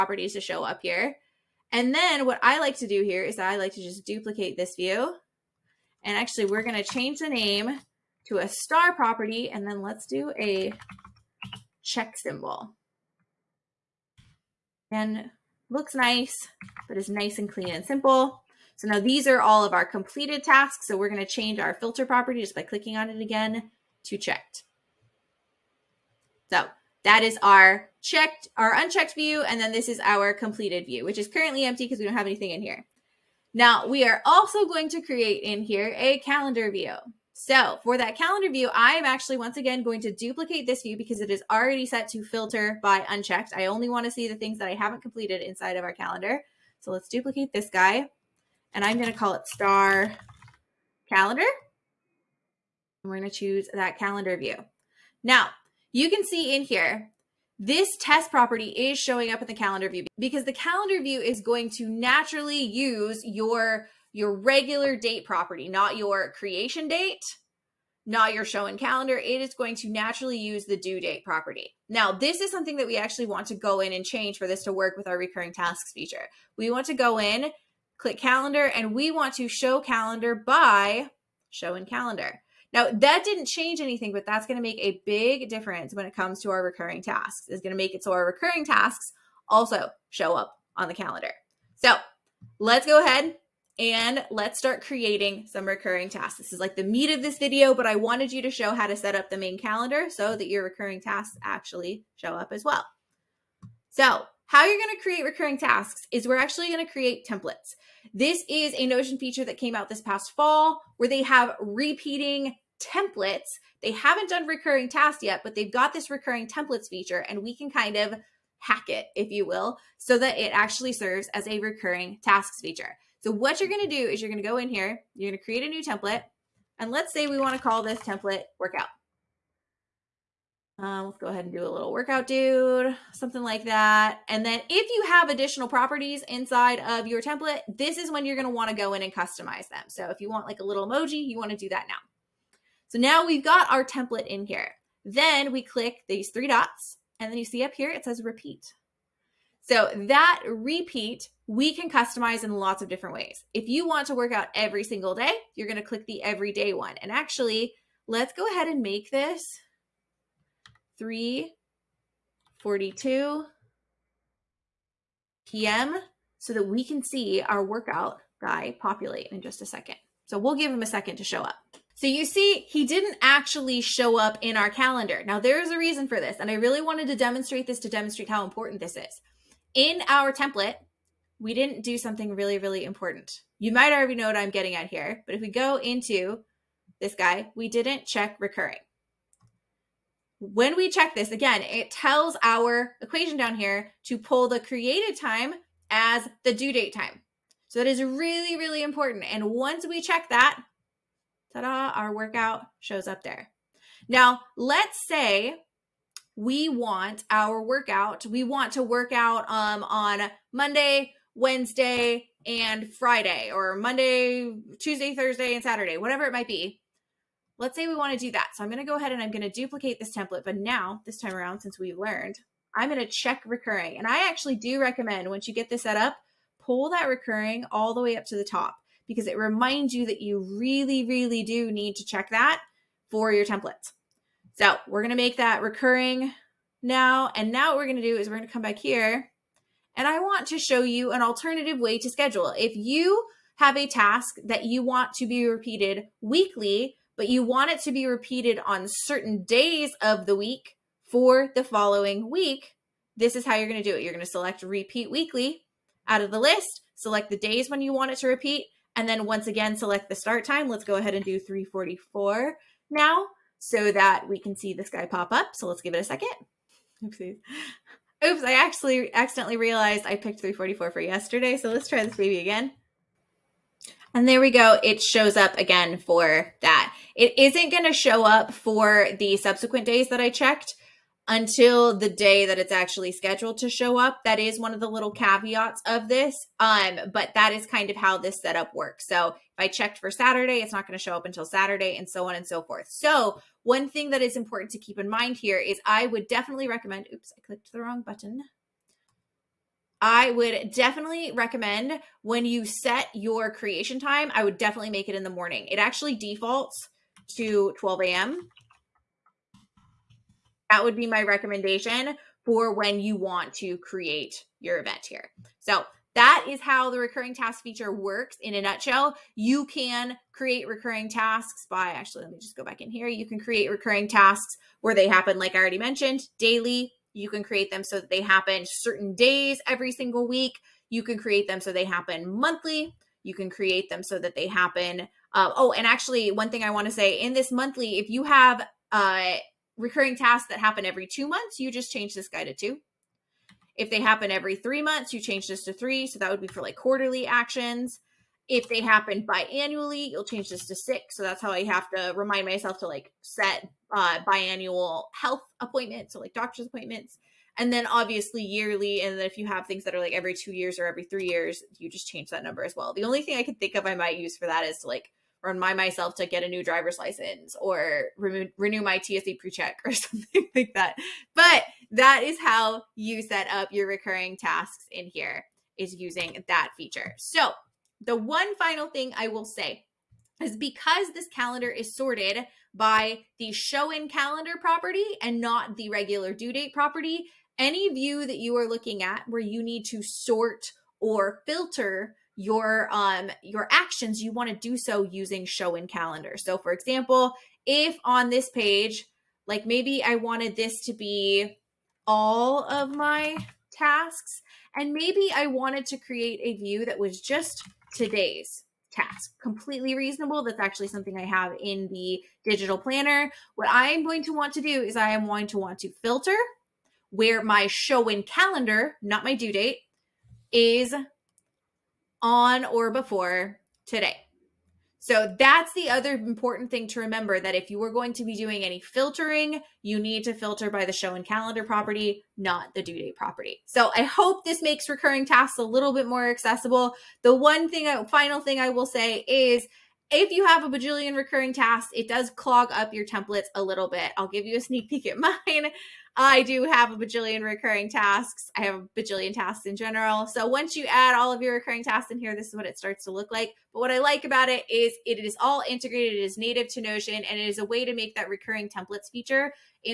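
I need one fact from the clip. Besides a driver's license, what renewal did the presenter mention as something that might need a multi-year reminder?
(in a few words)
TSA pre-check.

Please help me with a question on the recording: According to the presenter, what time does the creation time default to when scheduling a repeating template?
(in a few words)
12 a.m.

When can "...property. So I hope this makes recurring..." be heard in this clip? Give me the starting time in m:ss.
7:13.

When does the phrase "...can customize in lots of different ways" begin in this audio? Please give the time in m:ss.
2:31.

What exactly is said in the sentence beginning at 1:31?
So let's go ahead and let's start creating some recurring tasks.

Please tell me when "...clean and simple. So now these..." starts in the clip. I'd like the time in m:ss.
0:17.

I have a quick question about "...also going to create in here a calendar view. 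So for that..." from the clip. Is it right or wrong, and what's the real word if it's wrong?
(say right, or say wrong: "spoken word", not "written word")
right.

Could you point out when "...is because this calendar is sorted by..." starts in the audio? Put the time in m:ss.
6:20.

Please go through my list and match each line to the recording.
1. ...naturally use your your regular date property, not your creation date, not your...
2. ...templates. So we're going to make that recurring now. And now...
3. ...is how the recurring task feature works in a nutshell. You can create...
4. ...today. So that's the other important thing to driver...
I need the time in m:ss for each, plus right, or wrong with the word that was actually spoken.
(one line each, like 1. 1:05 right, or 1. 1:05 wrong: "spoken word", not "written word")
1. 1:01 right
2. 3:53 right
3. 5:16 right
4. 7:03 wrong: "remember", not "driver".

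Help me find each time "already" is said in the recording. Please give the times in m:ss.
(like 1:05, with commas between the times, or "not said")
0:41, 3:03, 5:25.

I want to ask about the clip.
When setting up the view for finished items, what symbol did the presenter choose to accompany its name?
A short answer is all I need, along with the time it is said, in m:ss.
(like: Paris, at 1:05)
check symbol, at 0:11.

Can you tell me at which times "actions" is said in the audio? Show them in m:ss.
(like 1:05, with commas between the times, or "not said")
5:47, 6:33.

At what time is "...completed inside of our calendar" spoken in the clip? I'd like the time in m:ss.
0:45.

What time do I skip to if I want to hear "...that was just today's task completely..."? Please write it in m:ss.
6:46.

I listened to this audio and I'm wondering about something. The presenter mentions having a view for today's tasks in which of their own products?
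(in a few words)
digital planner.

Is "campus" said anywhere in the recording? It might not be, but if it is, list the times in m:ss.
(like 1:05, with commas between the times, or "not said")
not said.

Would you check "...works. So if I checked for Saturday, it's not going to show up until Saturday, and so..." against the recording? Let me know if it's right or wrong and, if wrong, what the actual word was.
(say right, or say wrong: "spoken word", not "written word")
right.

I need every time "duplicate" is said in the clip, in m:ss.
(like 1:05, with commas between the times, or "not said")
0:04, 0:40, 0:47, 3:39.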